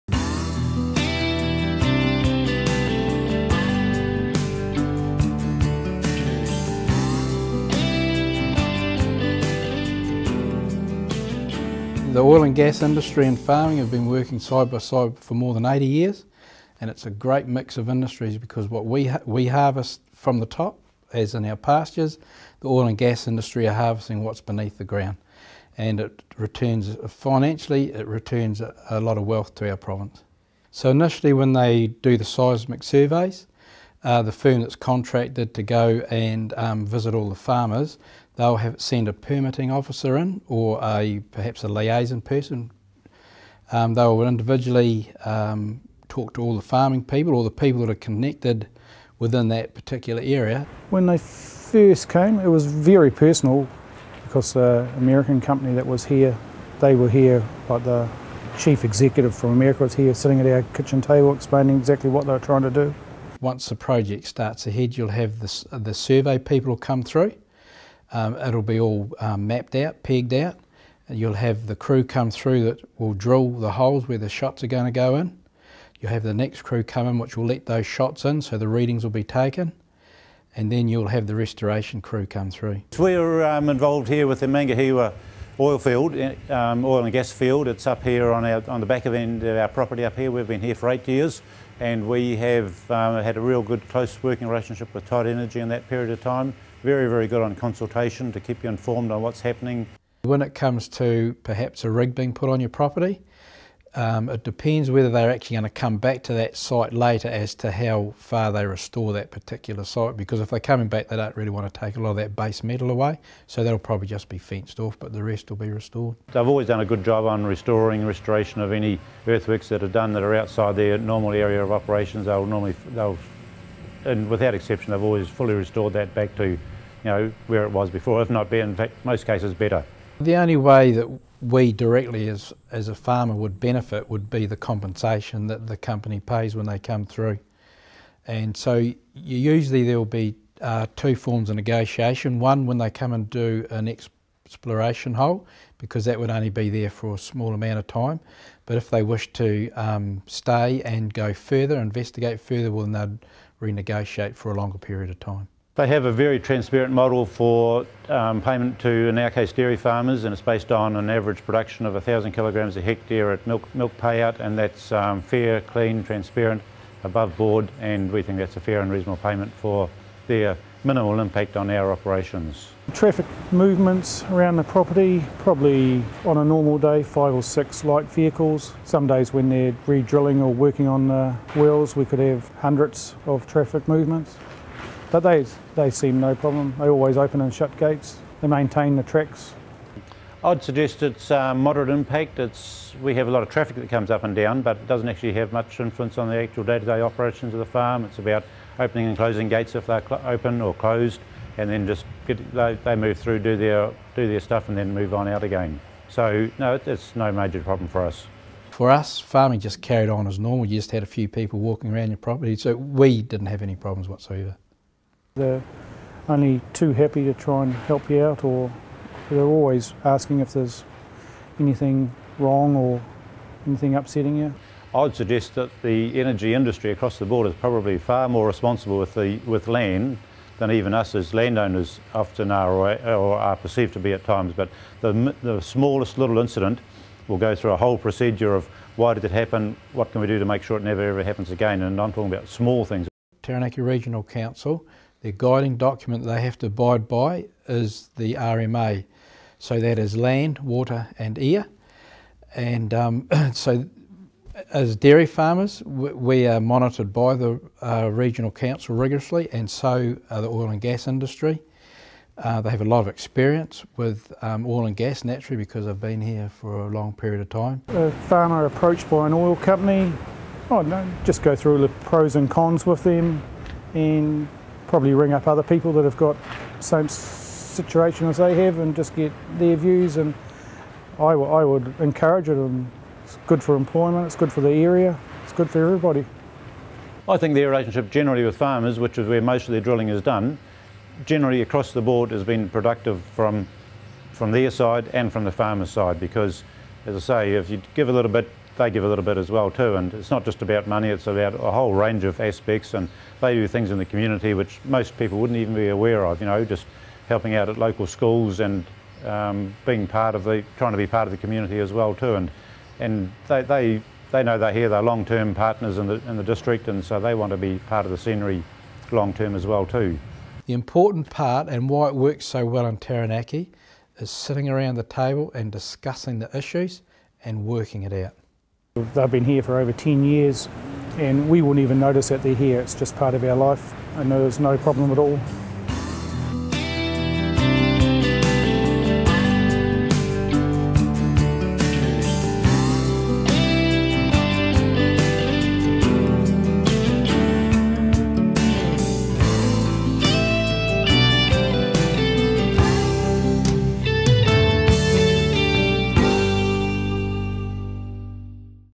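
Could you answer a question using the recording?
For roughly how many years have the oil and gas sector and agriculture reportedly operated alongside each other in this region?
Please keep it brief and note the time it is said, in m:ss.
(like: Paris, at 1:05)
80 years, at 0:15.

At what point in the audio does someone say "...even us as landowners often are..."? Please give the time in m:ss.
3:50.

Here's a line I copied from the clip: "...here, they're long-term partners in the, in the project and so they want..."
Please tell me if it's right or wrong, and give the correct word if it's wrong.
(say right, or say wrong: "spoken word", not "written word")
wrong: "district", not "project".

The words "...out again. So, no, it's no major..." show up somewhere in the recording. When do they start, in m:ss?
3:25.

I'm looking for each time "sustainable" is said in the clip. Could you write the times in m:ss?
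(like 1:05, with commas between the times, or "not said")
not said.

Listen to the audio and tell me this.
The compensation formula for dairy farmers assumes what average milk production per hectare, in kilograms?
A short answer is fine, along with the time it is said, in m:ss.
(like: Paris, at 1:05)
1,000 kilograms, at 2:41.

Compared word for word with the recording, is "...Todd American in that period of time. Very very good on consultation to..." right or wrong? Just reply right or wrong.
wrong.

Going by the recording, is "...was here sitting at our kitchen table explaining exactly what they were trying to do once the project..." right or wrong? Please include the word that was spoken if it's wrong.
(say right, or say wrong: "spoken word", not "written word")
right.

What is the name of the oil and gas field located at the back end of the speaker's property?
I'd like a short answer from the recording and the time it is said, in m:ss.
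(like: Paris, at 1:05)
Mangahewa, at 1:24.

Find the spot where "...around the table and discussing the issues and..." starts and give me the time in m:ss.
5:24.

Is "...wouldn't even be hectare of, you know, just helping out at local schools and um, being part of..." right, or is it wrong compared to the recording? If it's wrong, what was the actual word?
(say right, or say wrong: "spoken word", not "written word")
wrong: "aware", not "hectare".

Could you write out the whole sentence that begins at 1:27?
It's up here on our on the back of end of our property up here.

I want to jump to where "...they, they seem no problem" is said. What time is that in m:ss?
3:05.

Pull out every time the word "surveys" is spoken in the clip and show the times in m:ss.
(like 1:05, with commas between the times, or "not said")
0:32, 1:05.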